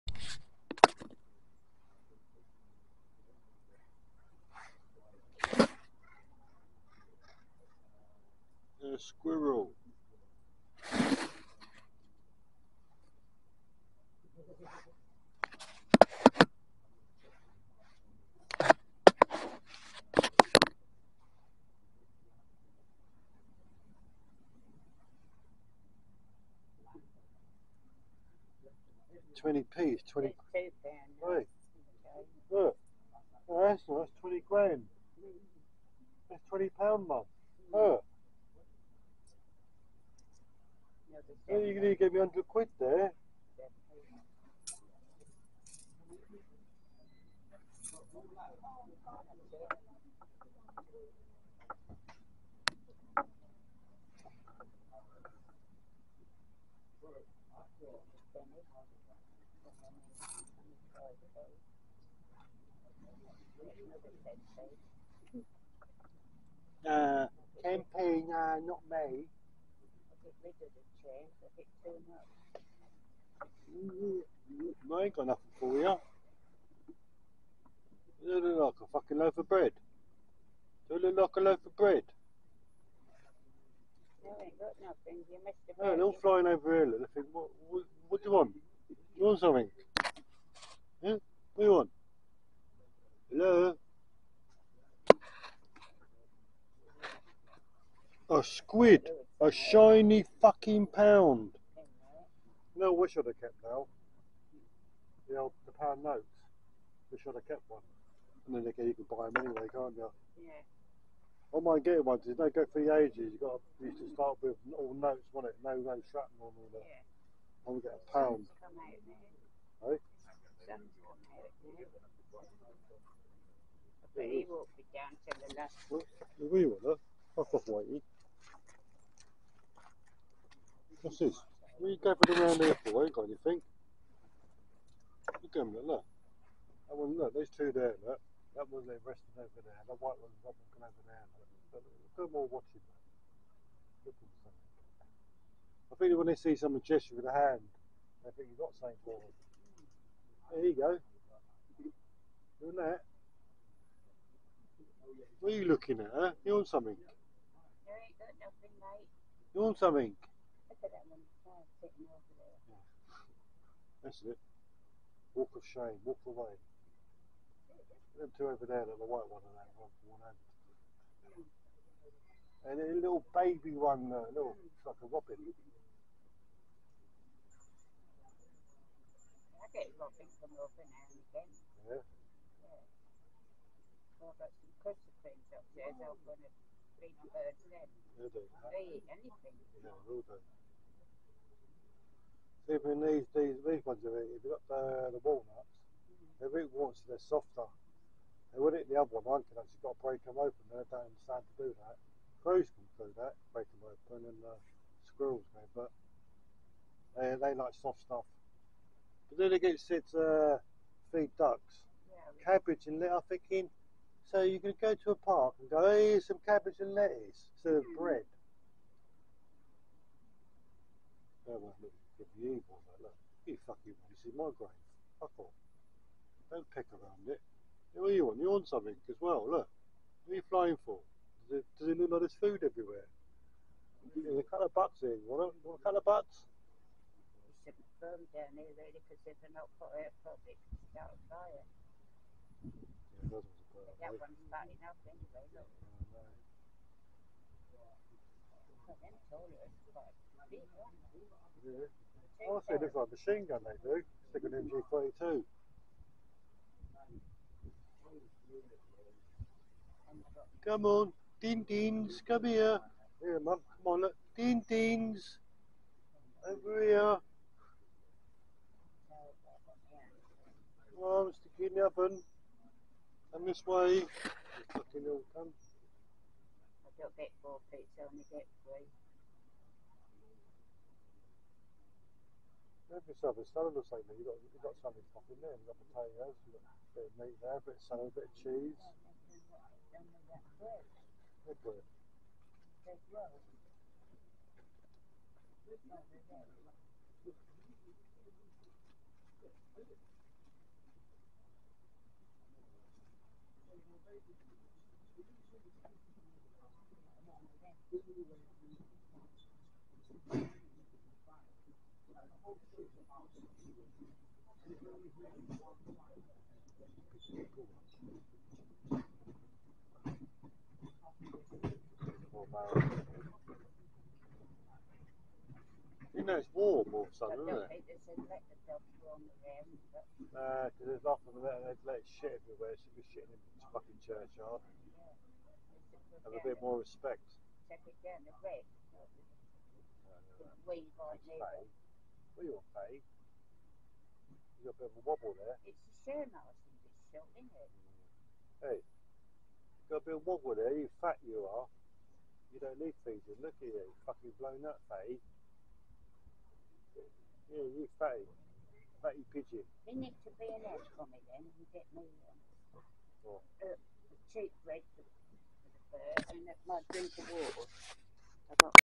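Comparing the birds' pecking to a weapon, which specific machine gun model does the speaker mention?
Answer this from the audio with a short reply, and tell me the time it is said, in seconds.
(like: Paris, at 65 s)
MG 42, at 254 s.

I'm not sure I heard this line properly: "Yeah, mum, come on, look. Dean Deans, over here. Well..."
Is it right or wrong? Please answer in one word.
right.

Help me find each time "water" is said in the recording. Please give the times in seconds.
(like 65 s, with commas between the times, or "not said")
368 s.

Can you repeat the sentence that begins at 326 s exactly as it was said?
You know it's warm all of a sudden, isn't it?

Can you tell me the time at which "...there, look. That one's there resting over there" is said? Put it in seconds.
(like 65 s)
137 s.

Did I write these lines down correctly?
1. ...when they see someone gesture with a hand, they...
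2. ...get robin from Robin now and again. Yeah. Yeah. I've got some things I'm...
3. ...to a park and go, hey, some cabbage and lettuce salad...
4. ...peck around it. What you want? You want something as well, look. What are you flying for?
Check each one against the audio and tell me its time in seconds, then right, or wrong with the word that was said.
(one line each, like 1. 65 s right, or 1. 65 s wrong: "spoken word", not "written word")
1. 146 s right
2. 179 s right
3. 214 s wrong: "instead", not "salad"
4. 226 s right.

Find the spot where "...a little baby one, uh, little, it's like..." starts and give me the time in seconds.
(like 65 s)
172 s.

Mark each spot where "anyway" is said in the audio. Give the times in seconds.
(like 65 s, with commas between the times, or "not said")
109 s, 245 s.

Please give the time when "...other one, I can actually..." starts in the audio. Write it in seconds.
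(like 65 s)
198 s.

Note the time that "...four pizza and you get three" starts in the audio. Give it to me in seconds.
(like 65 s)
277 s.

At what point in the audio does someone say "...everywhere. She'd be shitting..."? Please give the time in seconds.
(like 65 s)
332 s.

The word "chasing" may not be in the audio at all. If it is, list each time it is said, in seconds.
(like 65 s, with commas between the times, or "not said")
not said.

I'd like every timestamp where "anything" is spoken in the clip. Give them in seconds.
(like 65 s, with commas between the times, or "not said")
133 s, 189 s.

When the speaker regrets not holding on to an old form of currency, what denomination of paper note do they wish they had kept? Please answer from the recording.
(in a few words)
pound notes.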